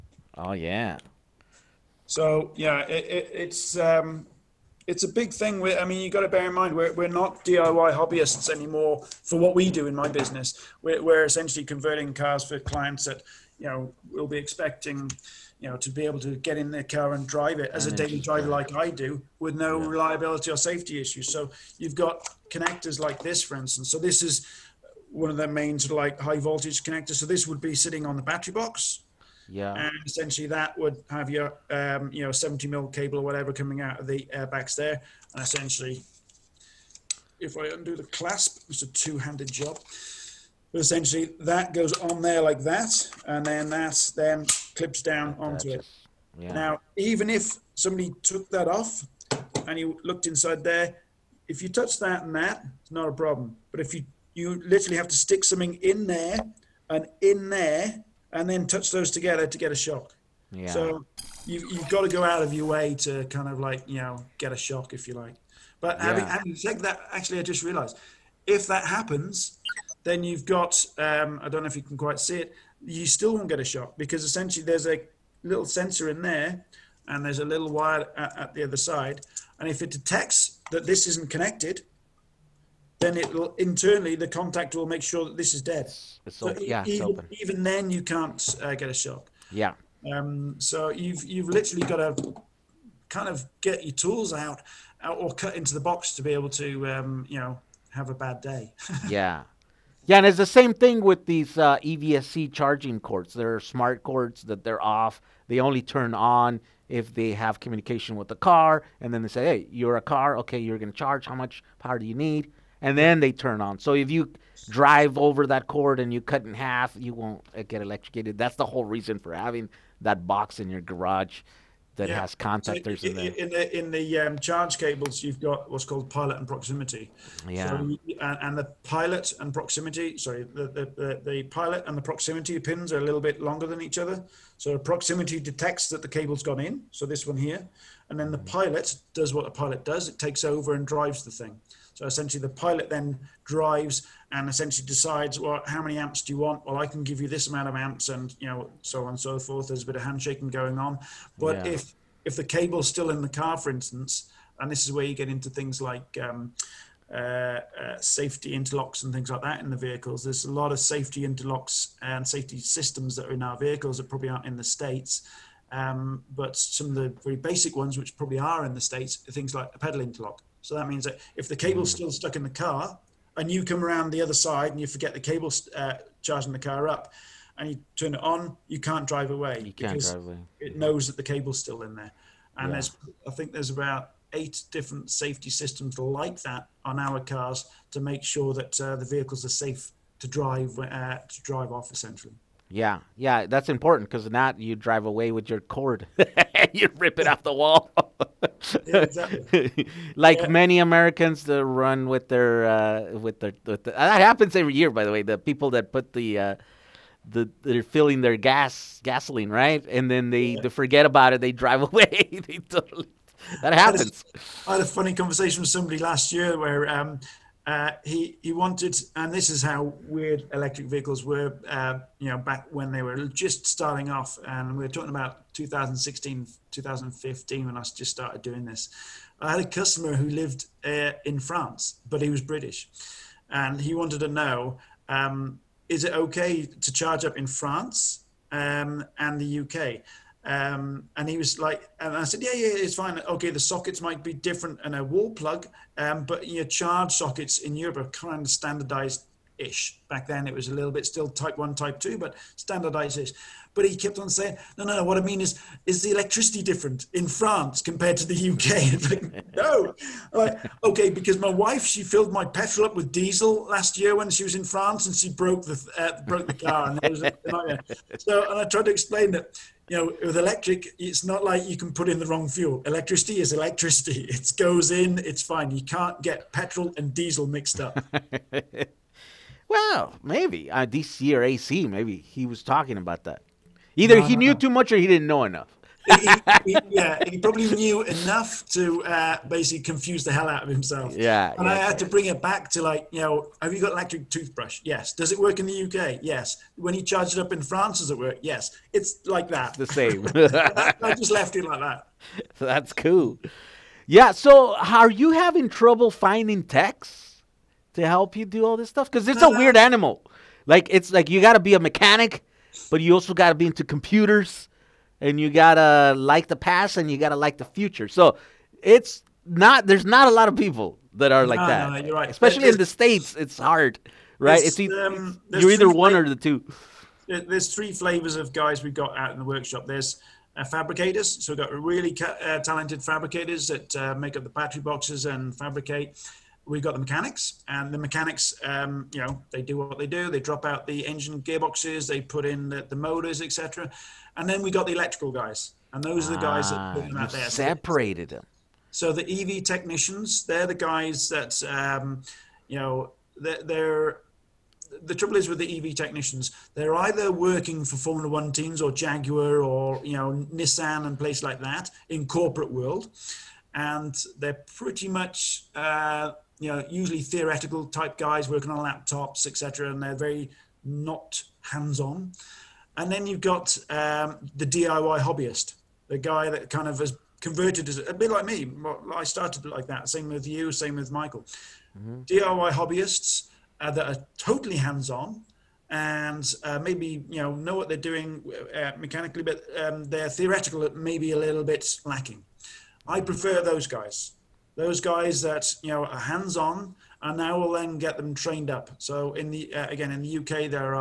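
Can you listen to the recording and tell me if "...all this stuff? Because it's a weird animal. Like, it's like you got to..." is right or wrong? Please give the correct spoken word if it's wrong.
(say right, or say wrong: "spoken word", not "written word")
right.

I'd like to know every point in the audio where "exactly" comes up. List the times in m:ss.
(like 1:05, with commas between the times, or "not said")
3:18.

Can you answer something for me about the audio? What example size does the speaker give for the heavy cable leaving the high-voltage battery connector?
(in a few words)
70 mil.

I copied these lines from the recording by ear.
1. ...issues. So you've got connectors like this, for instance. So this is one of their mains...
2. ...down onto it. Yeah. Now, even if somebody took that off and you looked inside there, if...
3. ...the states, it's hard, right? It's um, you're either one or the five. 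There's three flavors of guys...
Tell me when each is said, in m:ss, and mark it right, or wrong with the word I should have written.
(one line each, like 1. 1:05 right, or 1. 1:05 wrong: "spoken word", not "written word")
1. 0:21 right
2. 0:45 right
3. 5:22 wrong: "two", not "five".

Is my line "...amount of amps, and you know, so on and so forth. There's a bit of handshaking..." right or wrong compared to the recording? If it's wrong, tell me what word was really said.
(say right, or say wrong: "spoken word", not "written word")
right.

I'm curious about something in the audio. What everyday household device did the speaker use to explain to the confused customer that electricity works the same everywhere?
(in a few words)
electric toothbrush.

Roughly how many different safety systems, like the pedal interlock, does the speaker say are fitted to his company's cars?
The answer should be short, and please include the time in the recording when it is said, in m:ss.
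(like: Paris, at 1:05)
8, at 3:04.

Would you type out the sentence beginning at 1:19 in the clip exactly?
And if it detects that this isn't connected, then it will internally the contact will make sure that this is dead.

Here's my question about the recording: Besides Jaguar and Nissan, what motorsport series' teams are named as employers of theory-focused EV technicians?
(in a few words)
Formula One.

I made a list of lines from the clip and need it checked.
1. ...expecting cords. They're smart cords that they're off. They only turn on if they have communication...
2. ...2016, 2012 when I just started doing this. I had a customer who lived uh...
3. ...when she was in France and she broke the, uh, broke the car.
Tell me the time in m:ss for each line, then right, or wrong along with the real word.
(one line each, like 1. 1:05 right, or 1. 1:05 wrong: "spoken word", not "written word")
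1. 1:42 wrong: "charging", not "expecting"
2. 3:45 wrong: "2015", not "2012"
3. 4:24 right.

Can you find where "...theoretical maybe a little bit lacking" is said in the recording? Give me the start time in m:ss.
6:30.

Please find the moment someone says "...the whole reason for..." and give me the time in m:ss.
1:58.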